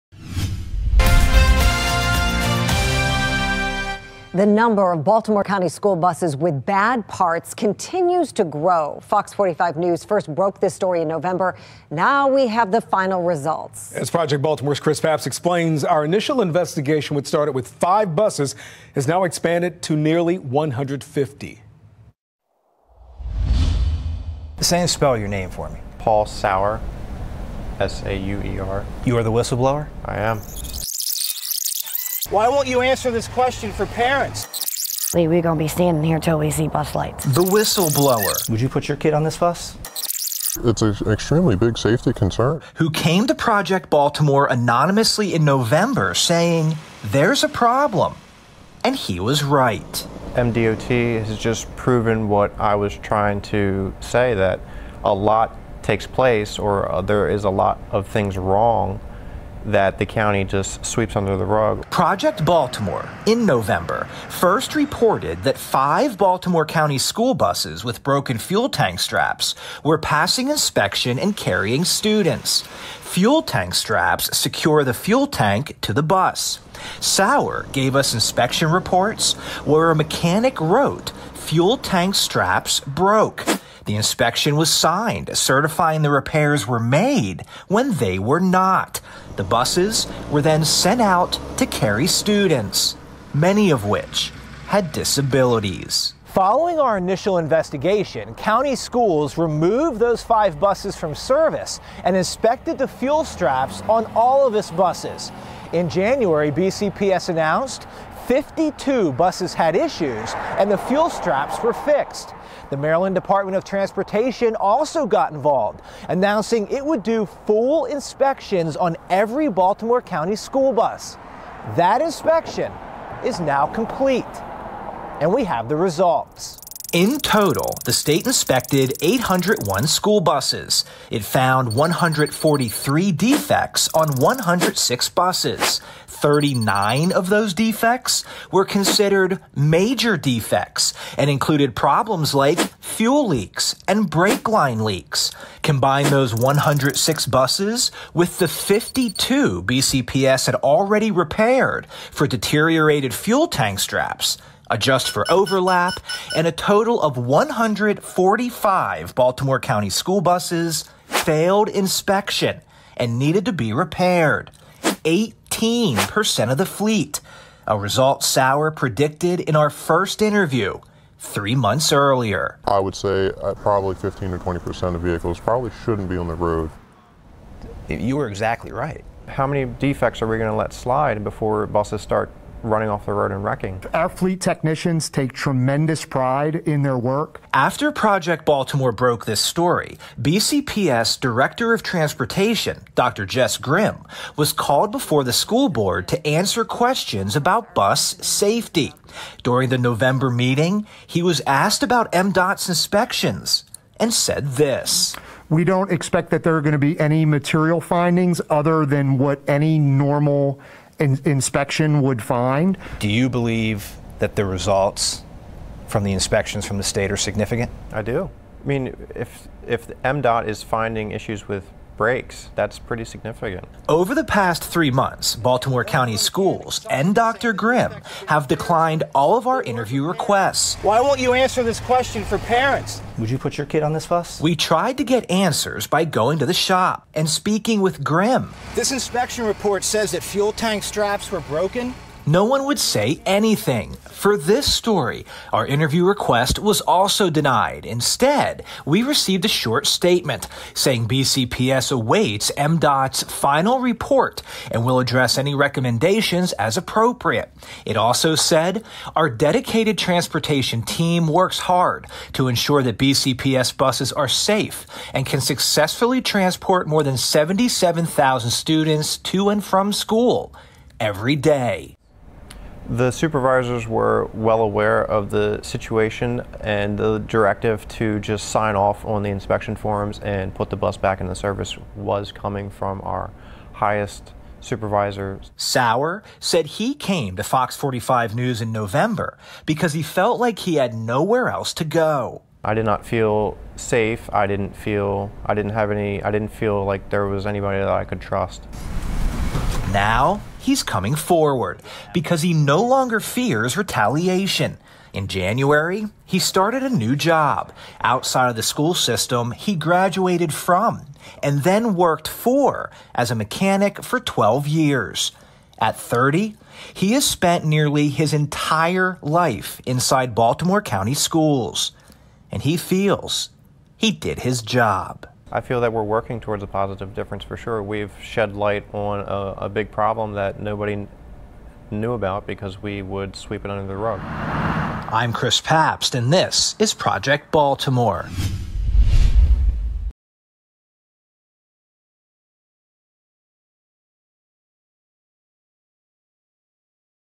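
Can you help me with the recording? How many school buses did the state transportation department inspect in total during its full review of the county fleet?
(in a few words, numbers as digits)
801.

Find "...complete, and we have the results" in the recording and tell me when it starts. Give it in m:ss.
2:03.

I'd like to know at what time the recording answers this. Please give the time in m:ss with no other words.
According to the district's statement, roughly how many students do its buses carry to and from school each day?
4:27.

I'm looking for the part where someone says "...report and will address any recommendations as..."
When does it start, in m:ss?
4:13.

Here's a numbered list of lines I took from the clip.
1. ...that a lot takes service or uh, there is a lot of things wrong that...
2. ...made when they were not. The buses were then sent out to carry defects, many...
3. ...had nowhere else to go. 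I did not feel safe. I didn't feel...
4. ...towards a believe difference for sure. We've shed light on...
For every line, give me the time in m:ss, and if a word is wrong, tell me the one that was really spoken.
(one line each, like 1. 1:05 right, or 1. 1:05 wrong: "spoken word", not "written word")
1. 0:54 wrong: "place", not "service"
2. 1:26 wrong: "students", not "defects"
3. 4:50 right
4. 5:26 wrong: "positive", not "believe".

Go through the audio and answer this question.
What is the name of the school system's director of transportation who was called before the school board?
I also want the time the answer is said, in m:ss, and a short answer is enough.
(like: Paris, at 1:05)
Dr. Jess Grimm, at 3:12.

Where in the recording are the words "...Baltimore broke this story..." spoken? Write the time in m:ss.
3:08.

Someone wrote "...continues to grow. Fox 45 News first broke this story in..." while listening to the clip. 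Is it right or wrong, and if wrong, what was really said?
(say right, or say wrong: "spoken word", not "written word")
right.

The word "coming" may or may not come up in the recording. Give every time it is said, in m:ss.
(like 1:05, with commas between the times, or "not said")
4:42, 5:00.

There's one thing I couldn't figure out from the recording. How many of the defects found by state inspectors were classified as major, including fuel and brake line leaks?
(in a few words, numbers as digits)
39.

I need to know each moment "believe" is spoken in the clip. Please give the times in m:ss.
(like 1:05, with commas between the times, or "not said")
3:33.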